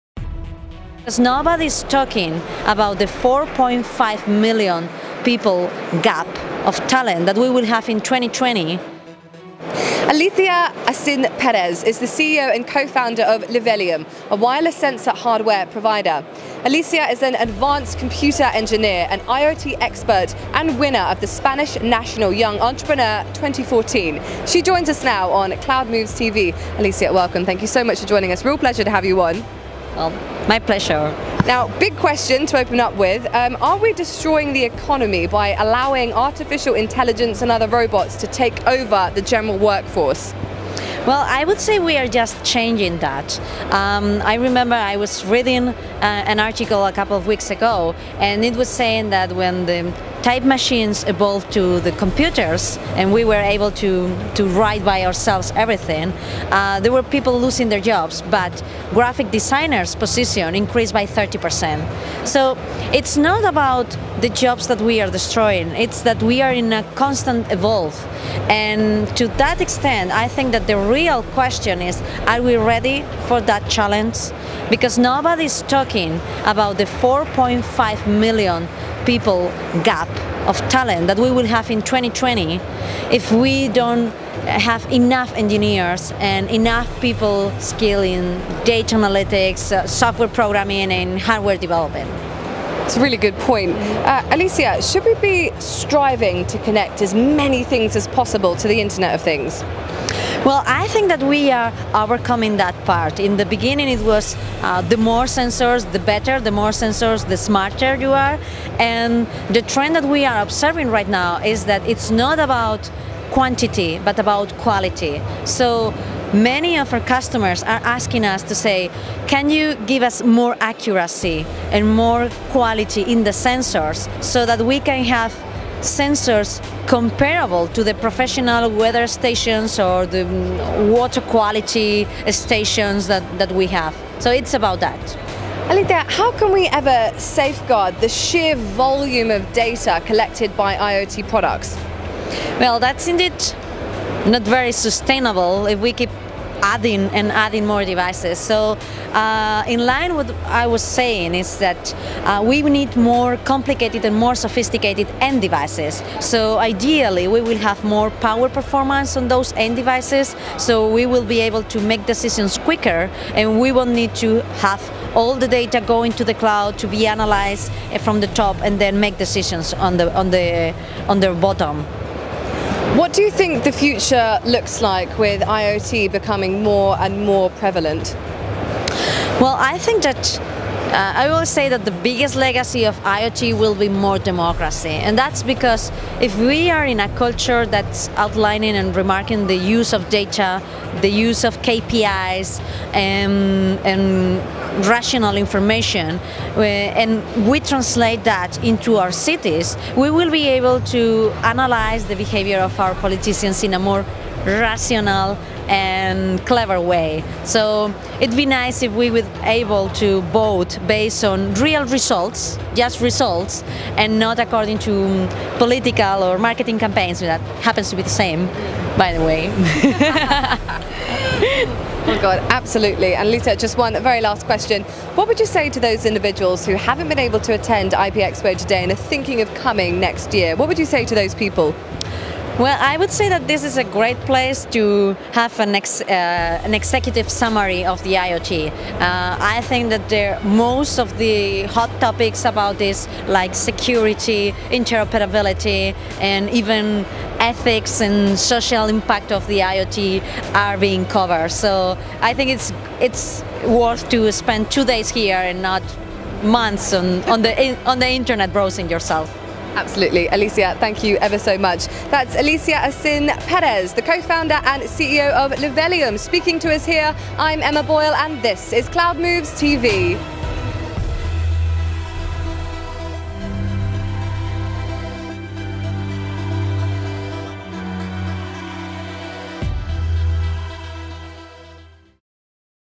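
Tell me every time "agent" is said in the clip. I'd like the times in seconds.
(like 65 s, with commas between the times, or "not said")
not said.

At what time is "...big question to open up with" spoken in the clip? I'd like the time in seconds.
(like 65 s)
31 s.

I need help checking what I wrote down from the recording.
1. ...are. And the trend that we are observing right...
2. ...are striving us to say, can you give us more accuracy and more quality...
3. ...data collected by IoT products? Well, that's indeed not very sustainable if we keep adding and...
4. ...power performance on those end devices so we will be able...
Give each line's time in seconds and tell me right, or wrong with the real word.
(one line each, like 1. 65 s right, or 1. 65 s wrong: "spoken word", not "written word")
1. 108 s right
2. 117 s wrong: "asking", not "striving"
3. 139 s right
4. 158 s right.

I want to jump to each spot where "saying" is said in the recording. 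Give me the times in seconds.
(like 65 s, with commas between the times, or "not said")
48 s, 150 s.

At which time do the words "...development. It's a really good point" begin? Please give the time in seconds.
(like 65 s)
91 s.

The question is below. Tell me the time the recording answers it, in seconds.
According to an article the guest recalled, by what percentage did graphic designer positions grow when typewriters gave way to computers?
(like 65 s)
61 s.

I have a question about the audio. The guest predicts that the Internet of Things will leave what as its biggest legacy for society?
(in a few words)
More democracy.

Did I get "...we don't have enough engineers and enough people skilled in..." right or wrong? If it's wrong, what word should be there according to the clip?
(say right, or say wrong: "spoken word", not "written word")
right.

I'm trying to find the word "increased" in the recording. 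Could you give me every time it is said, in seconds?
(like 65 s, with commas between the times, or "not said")
60 s.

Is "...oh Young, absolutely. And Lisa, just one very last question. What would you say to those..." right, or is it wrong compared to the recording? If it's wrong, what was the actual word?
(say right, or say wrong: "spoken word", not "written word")
wrong: "God", not "Young".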